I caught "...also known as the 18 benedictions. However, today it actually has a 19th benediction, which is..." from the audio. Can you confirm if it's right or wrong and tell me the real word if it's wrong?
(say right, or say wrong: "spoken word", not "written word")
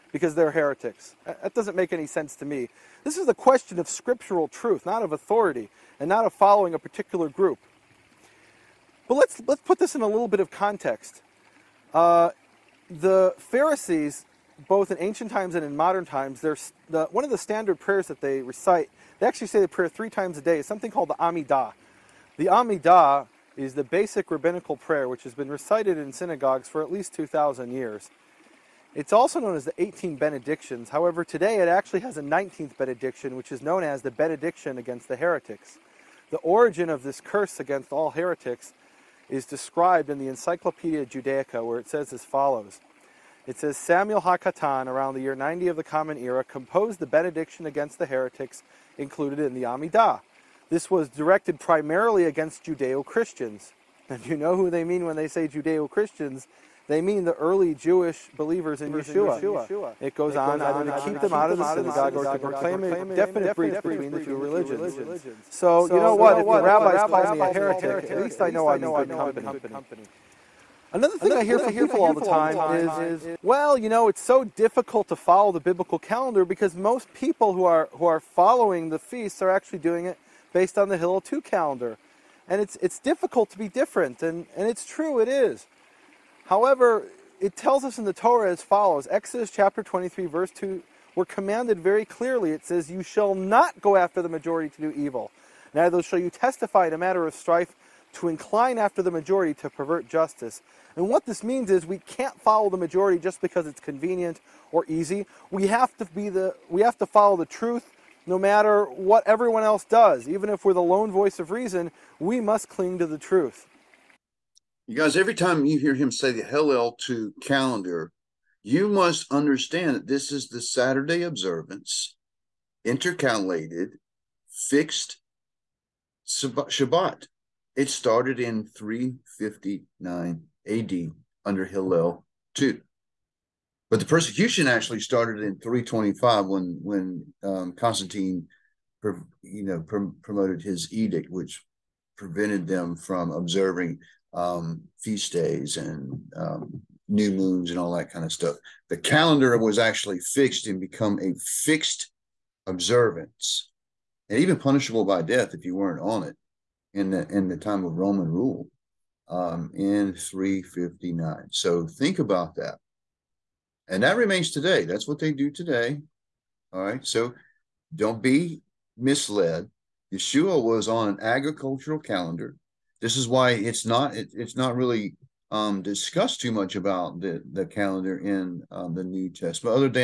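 right.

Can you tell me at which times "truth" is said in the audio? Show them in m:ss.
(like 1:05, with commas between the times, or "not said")
0:04, 1:47, 1:53.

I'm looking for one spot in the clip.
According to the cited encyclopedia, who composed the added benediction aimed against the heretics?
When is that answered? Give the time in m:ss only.
0:43.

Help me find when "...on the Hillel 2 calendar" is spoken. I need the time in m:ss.
1:20.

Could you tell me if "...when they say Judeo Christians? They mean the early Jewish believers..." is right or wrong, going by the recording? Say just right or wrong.
right.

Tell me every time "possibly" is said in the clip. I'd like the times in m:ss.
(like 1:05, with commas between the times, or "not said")
not said.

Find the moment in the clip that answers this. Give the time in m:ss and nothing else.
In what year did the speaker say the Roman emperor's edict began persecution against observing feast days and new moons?
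2:15.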